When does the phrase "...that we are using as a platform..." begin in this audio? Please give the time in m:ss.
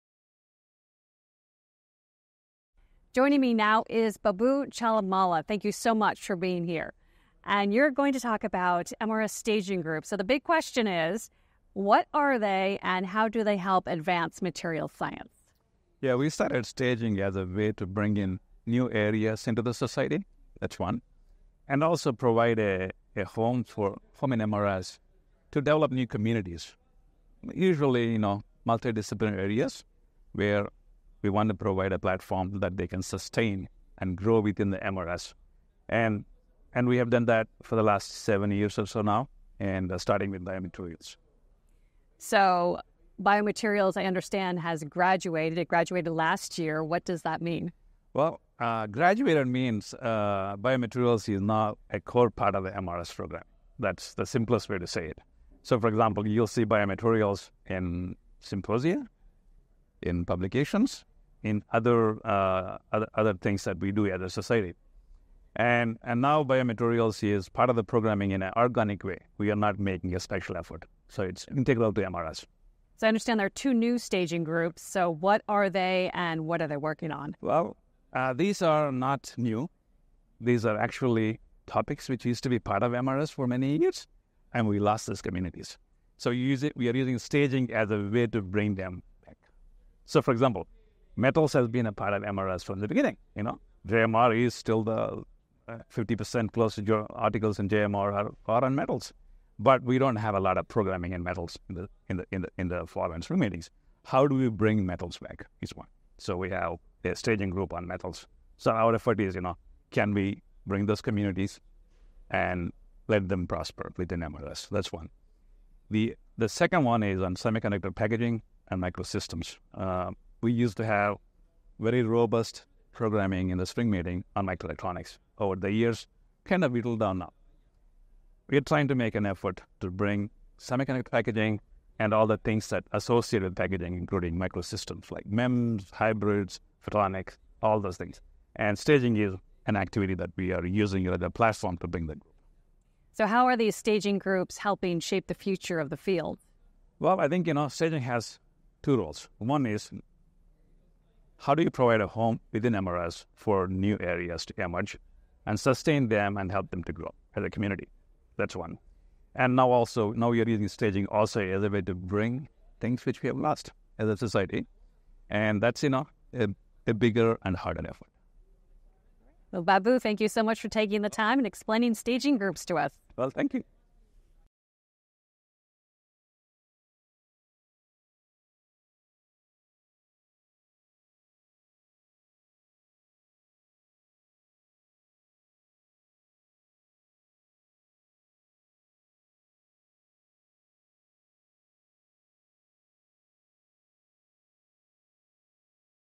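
2:20.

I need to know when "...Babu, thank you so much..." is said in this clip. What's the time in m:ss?
2:49.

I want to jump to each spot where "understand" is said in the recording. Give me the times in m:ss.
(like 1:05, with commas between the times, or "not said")
0:44, 1:13.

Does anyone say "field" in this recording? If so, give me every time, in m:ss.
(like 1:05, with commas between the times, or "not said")
2:25.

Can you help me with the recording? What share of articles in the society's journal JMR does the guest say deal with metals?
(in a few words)
50% plus.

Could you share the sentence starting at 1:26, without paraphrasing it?
So it, we are using staging as a way to bring them back.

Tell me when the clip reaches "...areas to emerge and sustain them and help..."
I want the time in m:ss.
2:33.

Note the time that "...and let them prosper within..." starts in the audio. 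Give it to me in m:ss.
1:52.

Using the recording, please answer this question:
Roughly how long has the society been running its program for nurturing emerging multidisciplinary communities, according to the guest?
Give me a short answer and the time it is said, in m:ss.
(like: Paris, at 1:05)
7 years, at 0:38.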